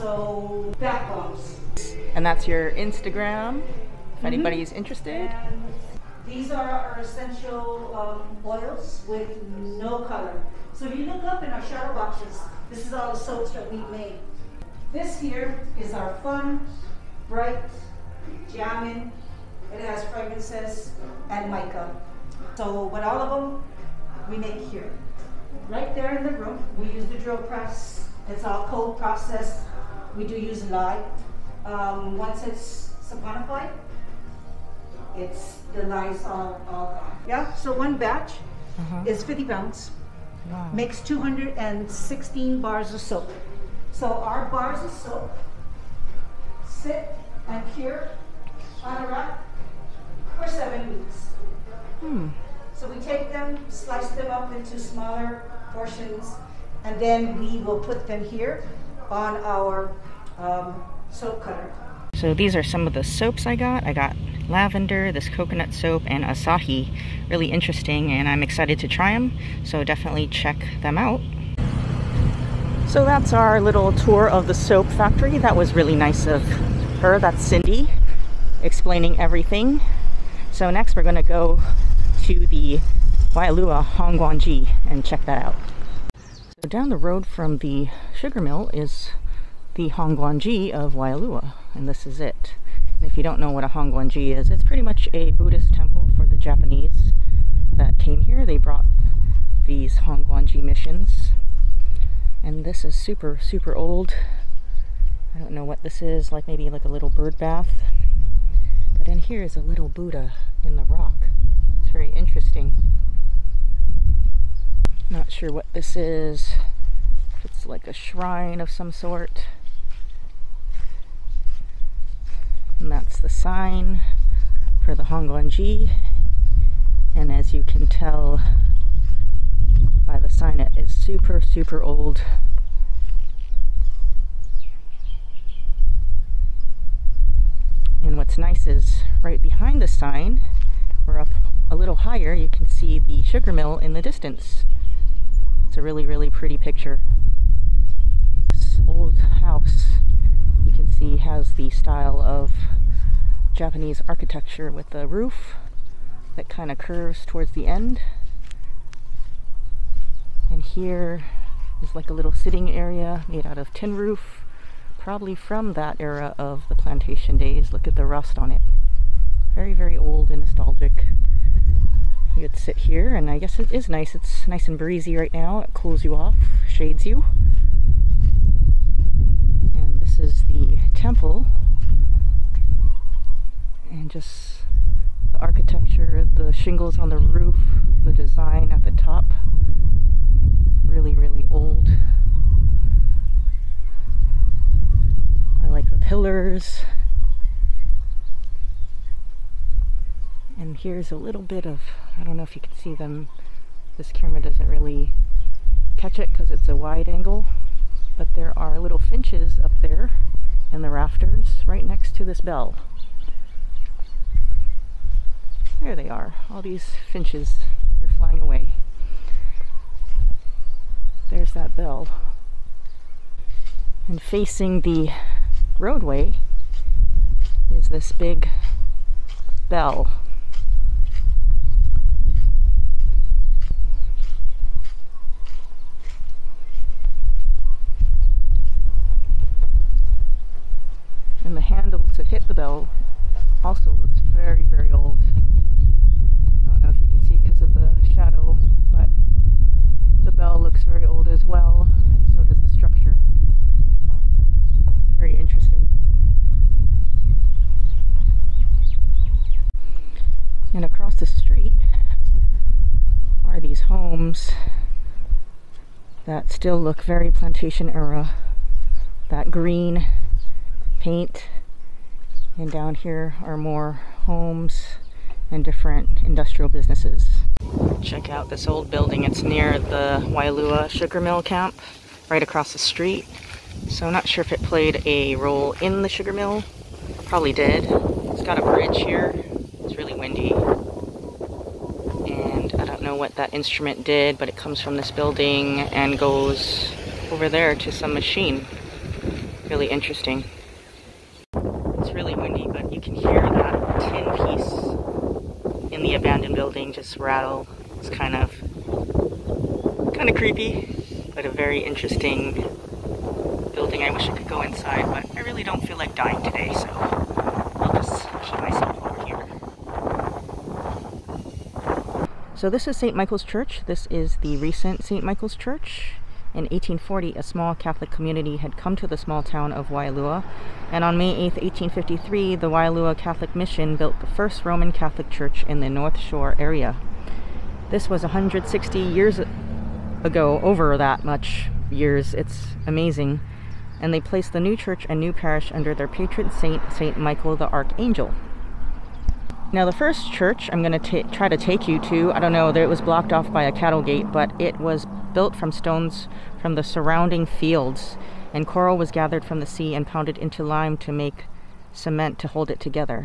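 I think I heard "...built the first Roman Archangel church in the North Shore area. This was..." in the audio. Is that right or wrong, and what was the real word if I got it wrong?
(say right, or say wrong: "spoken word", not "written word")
wrong: "Catholic", not "Archangel".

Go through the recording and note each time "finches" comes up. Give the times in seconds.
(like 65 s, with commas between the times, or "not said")
208 s, 217 s.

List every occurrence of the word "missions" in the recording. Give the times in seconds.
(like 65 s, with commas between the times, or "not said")
100 s, 333 s.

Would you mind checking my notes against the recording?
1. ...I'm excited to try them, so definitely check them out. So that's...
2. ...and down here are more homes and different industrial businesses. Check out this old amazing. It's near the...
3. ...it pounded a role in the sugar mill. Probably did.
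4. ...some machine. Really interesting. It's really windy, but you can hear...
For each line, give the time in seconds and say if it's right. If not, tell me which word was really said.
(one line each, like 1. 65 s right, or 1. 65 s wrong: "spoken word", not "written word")
1. 68 s right
2. 272 s wrong: "building", not "amazing"
3. 284 s wrong: "played", not "pounded"
4. 297 s right.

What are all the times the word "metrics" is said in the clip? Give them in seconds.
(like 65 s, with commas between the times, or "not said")
not said.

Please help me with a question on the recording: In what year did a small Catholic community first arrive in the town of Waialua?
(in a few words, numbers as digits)
1840.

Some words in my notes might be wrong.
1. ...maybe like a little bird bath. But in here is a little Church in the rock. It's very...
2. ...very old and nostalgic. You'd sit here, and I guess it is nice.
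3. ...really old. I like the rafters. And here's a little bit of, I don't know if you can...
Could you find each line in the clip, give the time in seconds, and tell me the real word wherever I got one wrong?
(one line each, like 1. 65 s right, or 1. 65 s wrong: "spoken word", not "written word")
1. 106 s wrong: "Buddha", not "Church"
2. 169 s right
3. 191 s wrong: "pillars", not "rafters".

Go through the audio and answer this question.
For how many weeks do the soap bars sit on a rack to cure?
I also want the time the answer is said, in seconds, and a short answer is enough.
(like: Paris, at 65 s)
7 weeks, at 50 s.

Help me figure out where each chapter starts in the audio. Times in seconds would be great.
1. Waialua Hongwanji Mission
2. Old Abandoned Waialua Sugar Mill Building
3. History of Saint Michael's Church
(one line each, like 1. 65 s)
1. 85 s
2. 276 s
3. 321 s.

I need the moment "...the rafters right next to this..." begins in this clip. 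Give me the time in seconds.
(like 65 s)
210 s.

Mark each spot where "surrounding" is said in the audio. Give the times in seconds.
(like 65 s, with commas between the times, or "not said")
356 s.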